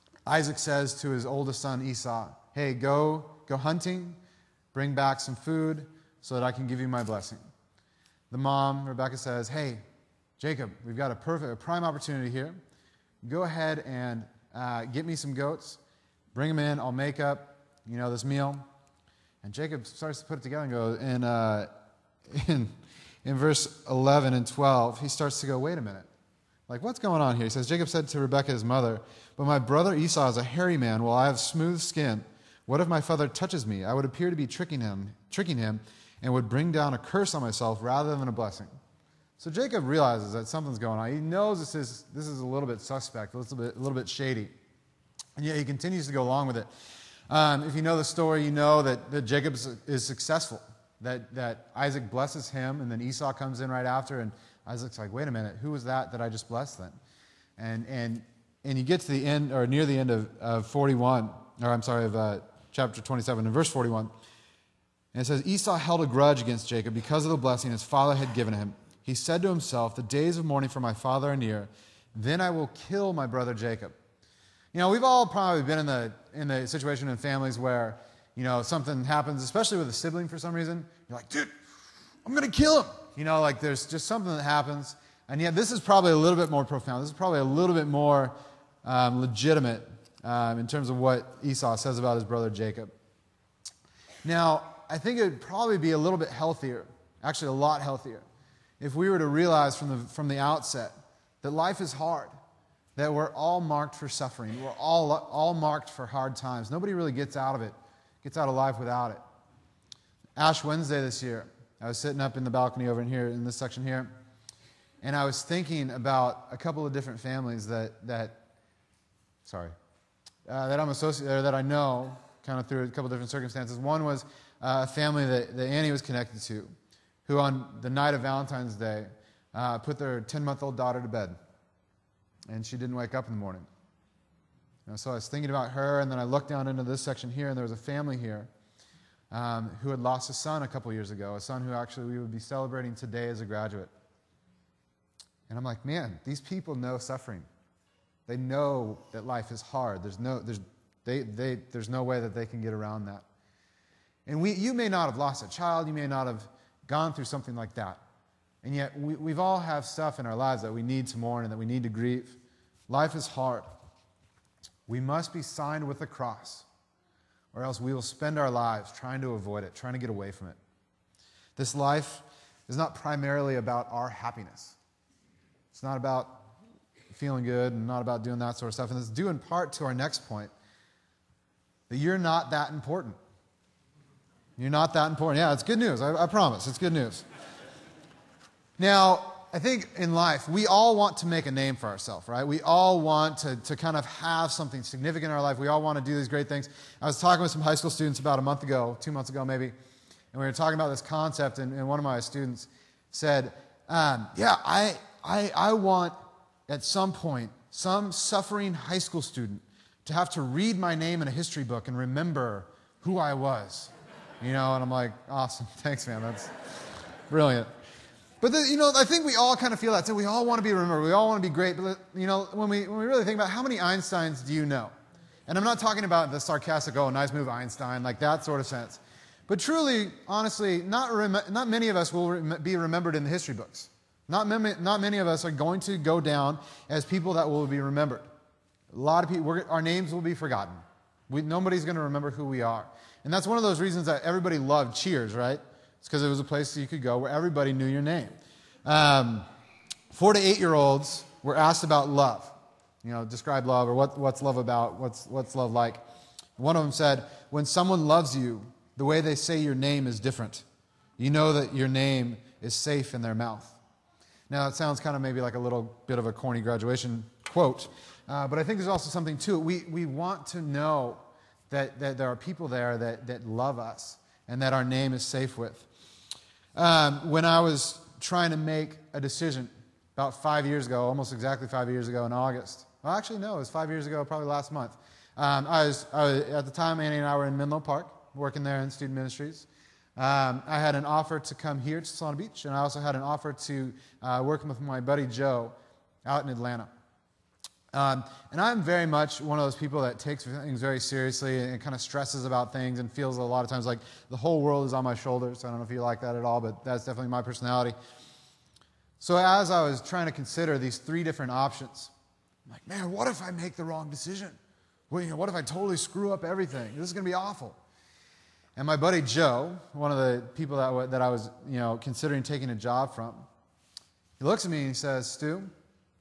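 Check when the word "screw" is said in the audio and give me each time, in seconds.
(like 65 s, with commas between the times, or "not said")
315 s.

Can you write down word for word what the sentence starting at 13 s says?
Go ahead and uh, get me some goats, bring them in.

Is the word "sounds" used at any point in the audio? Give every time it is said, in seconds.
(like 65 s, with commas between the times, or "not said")
264 s.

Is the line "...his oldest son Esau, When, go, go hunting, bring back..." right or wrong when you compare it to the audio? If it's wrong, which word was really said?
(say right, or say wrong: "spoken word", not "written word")
wrong: "Hey", not "When".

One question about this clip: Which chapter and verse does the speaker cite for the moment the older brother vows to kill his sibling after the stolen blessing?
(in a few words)
Chapter 27, verse 41.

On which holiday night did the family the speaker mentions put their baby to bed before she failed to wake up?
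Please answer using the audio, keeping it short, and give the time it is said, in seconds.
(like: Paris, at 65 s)
Valentine's Day, at 128 s.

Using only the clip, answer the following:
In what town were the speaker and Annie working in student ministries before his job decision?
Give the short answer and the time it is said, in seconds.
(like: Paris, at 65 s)
Menlo Park, at 287 s.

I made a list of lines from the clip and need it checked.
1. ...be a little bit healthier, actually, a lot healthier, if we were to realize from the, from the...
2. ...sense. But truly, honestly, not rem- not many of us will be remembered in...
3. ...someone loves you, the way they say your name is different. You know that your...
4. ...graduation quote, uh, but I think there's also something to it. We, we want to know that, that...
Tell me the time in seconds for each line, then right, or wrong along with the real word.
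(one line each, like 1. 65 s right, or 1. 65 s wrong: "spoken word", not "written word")
1. 95 s right
2. 228 s right
3. 257 s right
4. 266 s right.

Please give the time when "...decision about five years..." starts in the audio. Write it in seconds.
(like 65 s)
279 s.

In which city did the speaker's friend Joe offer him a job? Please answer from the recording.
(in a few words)
Atlanta.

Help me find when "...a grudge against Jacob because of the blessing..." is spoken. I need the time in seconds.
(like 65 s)
66 s.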